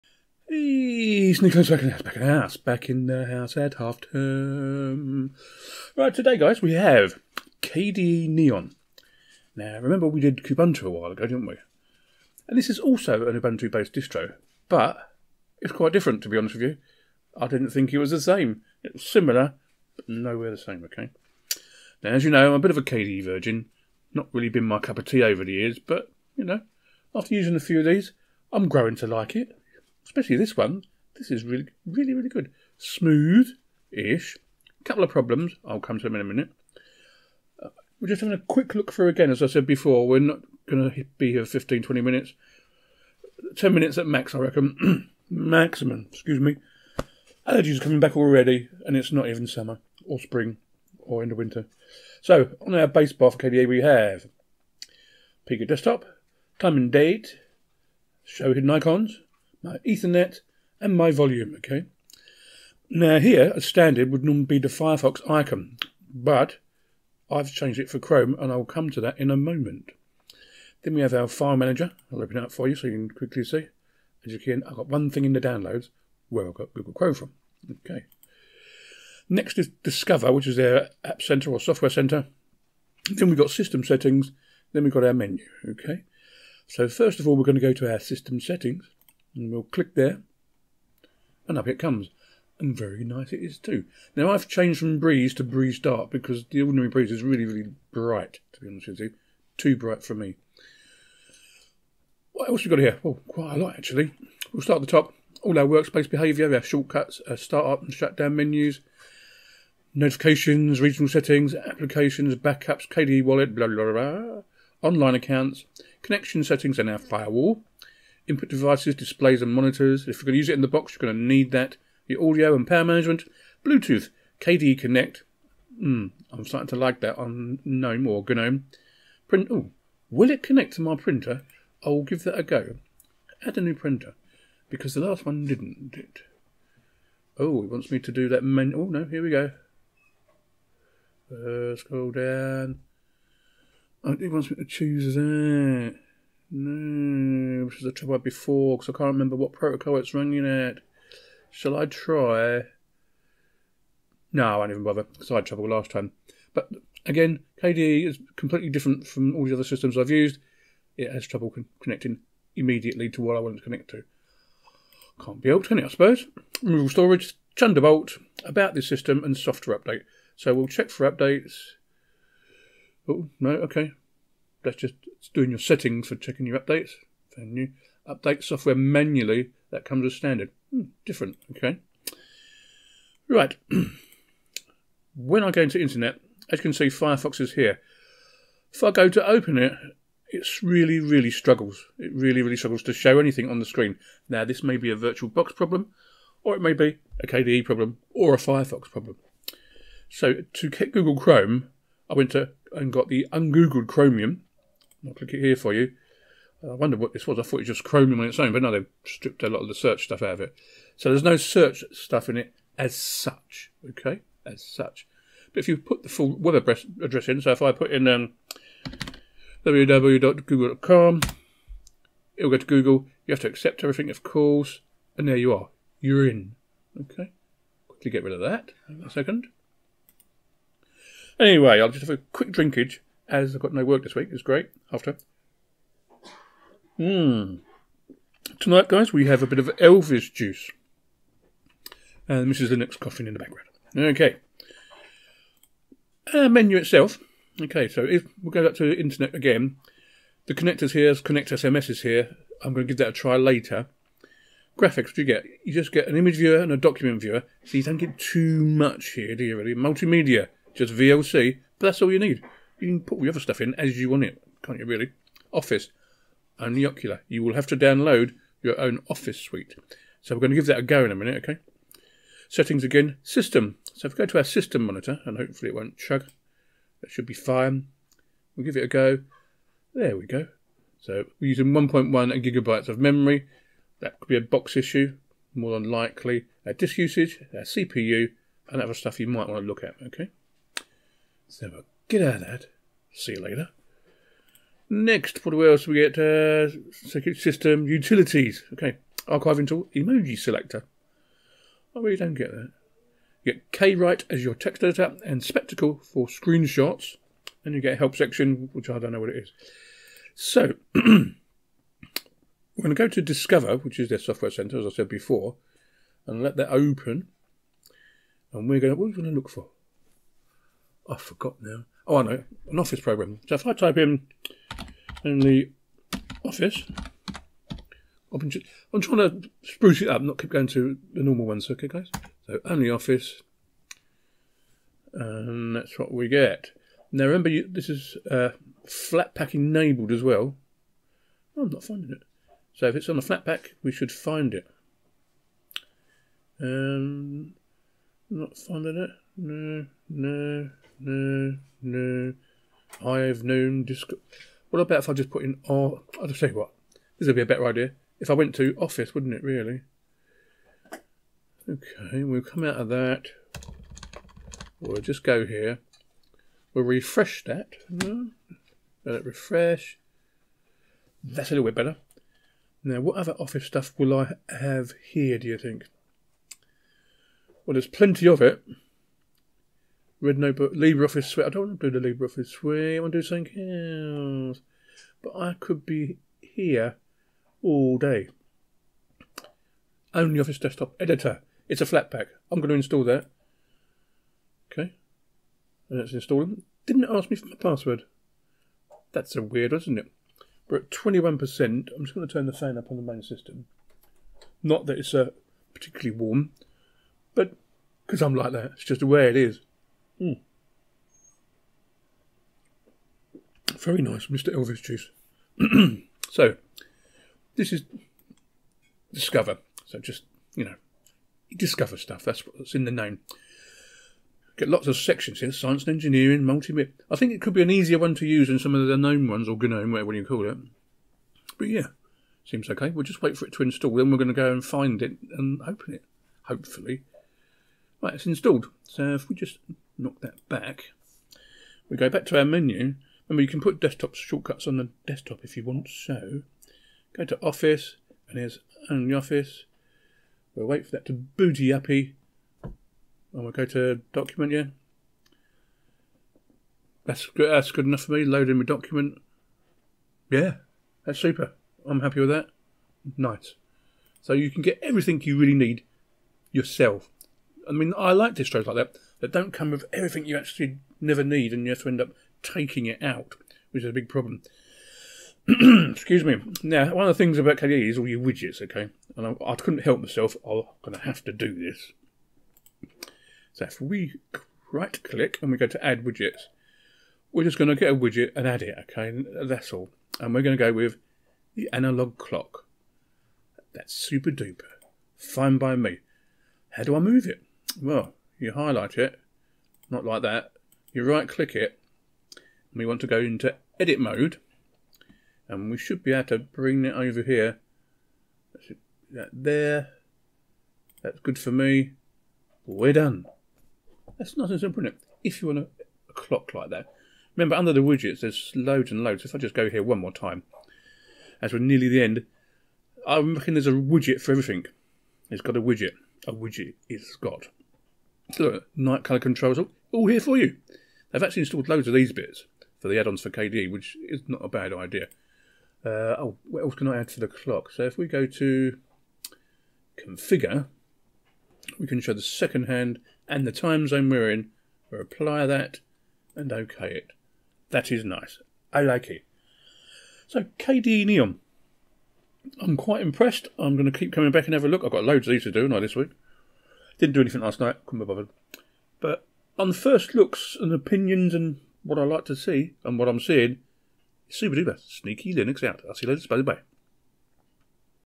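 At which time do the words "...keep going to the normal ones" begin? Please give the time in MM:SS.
05:30.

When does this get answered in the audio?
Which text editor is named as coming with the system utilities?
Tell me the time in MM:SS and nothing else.
05:03.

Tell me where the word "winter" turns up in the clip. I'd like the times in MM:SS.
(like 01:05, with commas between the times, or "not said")
00:51.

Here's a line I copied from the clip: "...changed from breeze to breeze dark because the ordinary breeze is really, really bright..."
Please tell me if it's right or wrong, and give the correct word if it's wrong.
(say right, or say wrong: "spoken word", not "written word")
right.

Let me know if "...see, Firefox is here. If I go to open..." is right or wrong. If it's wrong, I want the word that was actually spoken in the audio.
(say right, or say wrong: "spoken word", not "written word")
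right.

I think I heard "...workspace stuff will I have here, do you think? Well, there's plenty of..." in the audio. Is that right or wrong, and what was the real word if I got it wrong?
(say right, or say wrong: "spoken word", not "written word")
wrong: "office", not "workspace".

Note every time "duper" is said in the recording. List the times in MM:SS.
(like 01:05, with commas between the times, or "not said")
08:14, 09:24.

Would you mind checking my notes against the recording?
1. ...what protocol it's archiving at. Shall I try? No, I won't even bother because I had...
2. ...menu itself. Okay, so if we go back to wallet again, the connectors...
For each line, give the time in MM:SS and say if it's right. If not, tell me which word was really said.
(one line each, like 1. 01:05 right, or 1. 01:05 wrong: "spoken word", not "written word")
1. 02:29 wrong: "running", not "archiving"
2. 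04:06 wrong: "internet", not "wallet".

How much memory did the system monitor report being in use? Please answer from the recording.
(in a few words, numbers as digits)
1.1 gigabytes.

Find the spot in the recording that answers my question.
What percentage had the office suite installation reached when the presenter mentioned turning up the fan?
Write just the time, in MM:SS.
06:40.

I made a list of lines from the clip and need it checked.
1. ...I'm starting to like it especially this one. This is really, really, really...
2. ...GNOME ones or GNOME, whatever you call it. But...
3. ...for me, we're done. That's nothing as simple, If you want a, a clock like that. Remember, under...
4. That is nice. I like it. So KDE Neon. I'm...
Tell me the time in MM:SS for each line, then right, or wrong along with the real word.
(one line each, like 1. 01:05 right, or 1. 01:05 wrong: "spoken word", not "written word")
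1. 00:28 wrong: "growing", not "starting"
2. 07:08 right
3. 08:31 right
4. 09:07 right.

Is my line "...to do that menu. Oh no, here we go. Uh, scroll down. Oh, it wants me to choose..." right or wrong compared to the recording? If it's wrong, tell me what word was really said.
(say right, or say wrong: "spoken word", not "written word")
right.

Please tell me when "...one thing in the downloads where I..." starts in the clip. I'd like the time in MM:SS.
01:14.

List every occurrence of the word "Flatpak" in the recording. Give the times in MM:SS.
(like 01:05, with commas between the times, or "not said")
05:38, 05:43, 06:31.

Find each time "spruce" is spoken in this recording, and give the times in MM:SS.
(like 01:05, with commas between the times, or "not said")
05:29.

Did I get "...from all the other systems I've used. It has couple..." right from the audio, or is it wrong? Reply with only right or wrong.
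wrong.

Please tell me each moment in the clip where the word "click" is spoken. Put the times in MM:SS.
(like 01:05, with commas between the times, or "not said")
01:29, 03:25, 08:05, 08:21.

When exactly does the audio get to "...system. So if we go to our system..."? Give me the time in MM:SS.
04:33.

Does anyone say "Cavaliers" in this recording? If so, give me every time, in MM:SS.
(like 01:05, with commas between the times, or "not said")
not said.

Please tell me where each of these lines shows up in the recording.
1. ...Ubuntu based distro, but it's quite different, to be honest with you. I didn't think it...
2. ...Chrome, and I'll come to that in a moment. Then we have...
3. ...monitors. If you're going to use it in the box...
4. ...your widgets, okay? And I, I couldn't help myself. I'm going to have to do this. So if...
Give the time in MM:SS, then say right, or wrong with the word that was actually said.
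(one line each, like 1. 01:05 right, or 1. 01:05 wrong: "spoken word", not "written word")
1. 00:13 right
2. 01:07 right
3. 01:59 right
4. 07:58 right.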